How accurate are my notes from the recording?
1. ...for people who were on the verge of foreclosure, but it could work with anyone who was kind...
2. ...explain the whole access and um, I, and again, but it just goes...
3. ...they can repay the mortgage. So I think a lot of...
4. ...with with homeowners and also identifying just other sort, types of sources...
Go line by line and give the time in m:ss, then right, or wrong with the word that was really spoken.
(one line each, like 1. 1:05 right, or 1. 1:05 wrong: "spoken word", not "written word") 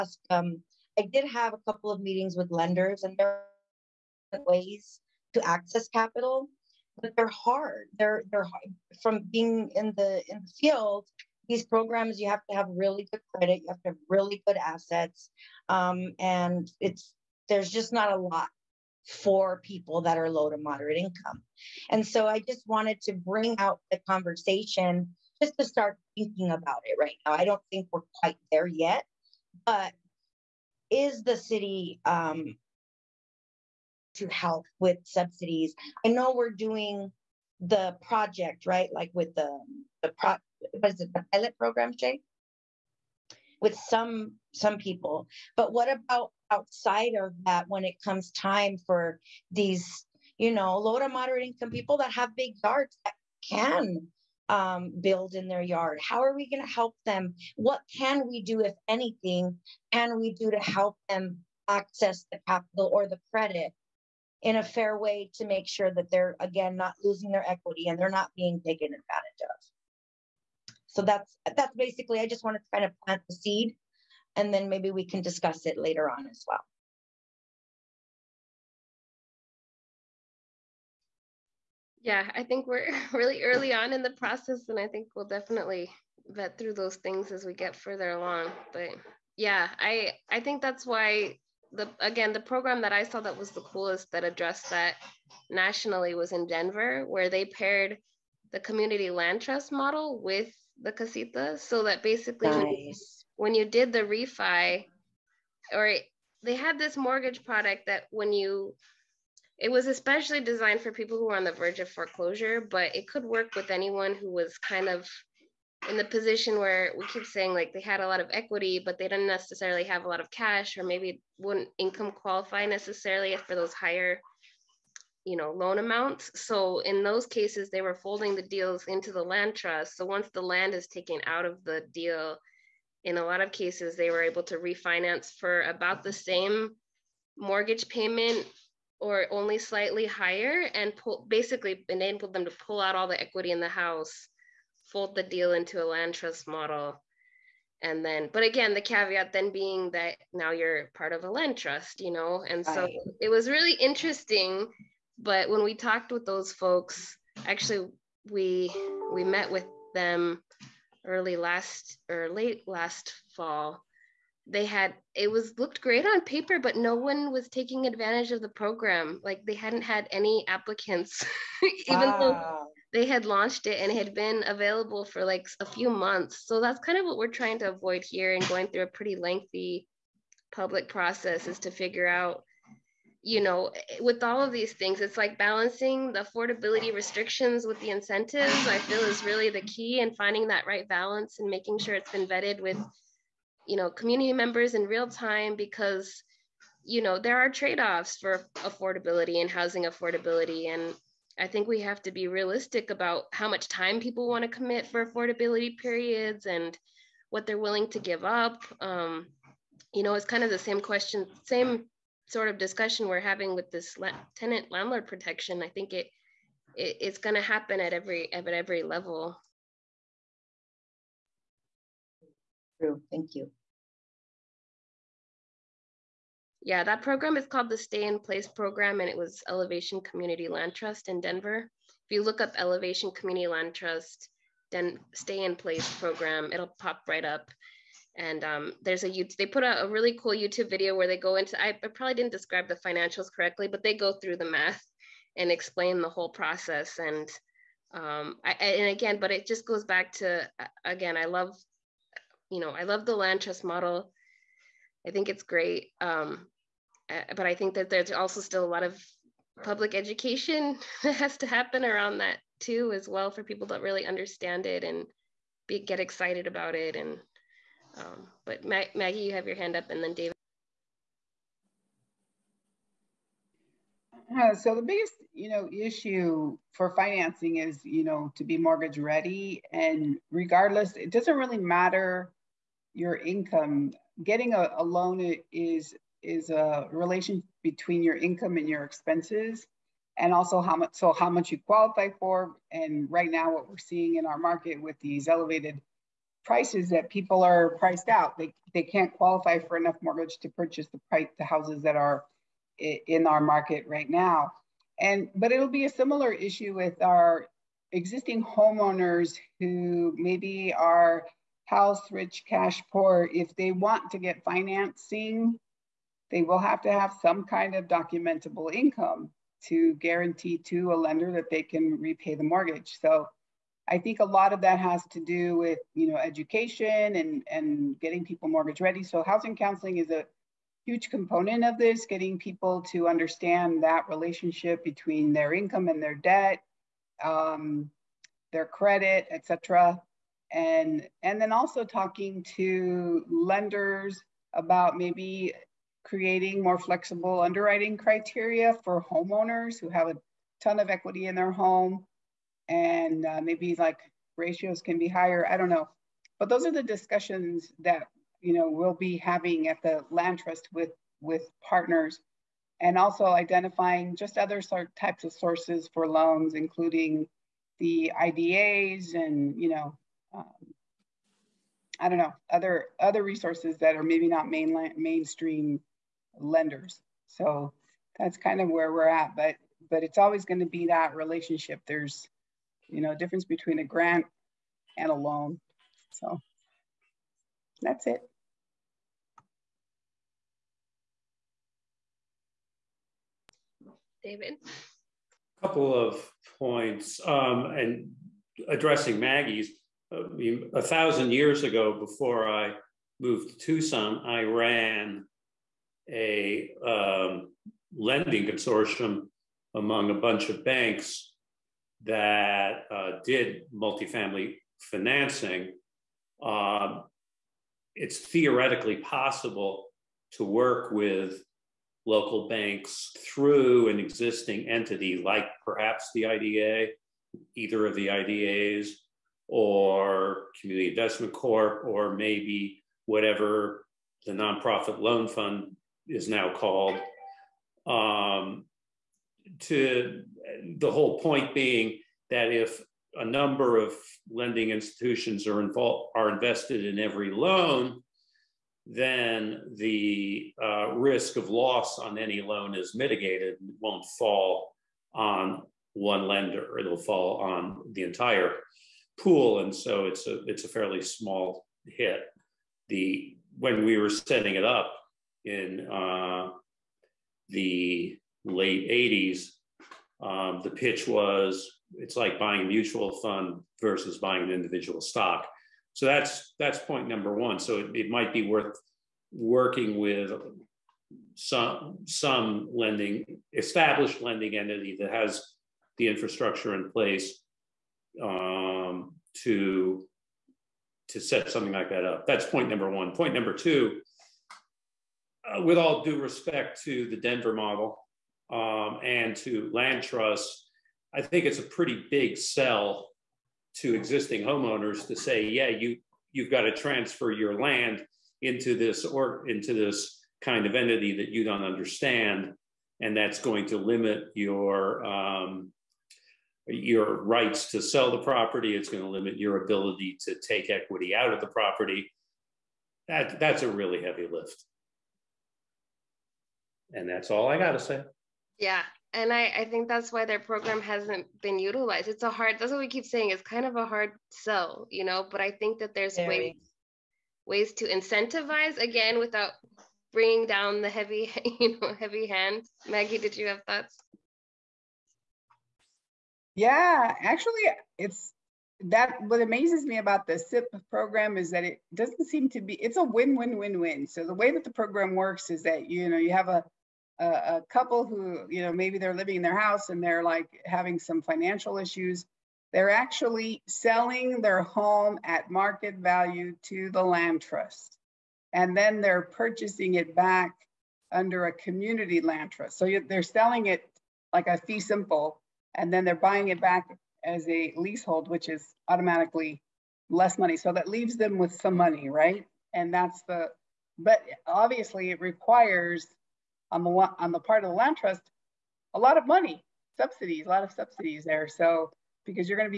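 1. 1:50 right
2. 4:05 wrong: "process", not "access"
3. 5:21 right
4. 6:00 wrong: "partners", not "homeowners".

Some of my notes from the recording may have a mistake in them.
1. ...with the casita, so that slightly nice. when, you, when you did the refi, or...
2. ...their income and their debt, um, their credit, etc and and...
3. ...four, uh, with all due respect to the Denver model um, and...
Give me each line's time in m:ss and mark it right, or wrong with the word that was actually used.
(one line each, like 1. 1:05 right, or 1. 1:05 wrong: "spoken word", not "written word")
1. 1:40 wrong: "basically", not "slightly"
2. 5:35 right
3. 8:13 wrong: "two", not "four".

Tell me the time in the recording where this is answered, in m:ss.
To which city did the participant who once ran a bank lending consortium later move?
6:43.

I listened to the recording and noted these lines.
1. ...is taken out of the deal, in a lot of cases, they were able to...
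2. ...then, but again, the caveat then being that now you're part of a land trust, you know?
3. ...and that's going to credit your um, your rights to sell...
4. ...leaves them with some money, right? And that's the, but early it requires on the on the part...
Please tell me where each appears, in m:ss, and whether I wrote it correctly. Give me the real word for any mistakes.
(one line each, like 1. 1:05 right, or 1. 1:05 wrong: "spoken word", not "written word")
1. 2:10 right
2. 2:28 right
3. 8:33 wrong: "limit", not "credit"
4. 9:40 wrong: "obviously", not "early".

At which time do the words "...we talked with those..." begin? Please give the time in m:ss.
2:35.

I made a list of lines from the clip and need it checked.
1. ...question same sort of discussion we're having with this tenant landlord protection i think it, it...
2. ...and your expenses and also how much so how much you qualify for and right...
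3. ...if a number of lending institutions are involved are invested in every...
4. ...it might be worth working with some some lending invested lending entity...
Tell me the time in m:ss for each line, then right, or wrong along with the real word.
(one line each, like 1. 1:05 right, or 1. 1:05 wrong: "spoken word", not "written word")
1. 3:30 right
2. 4:48 right
3. 7:22 right
4. 7:57 wrong: "established", not "invested".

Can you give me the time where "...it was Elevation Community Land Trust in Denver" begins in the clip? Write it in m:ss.
3:49.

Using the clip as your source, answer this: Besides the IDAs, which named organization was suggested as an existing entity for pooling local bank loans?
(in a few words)
Community Investment Corp.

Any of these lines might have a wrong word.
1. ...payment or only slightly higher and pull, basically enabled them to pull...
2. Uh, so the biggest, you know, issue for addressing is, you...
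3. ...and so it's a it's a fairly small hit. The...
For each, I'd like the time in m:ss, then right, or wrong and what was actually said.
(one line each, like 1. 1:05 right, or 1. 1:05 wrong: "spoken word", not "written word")
1. 2:17 right
2. 4:34 wrong: "financing", not "addressing"
3. 7:39 right.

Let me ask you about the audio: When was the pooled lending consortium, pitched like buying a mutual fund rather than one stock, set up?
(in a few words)
the late 1980s.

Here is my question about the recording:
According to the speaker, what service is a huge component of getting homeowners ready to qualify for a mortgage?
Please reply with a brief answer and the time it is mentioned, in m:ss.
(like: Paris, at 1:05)
Housing counseling, at 5:29.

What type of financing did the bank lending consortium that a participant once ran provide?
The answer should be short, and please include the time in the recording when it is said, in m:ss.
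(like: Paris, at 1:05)
Multifamily financing, at 6:53.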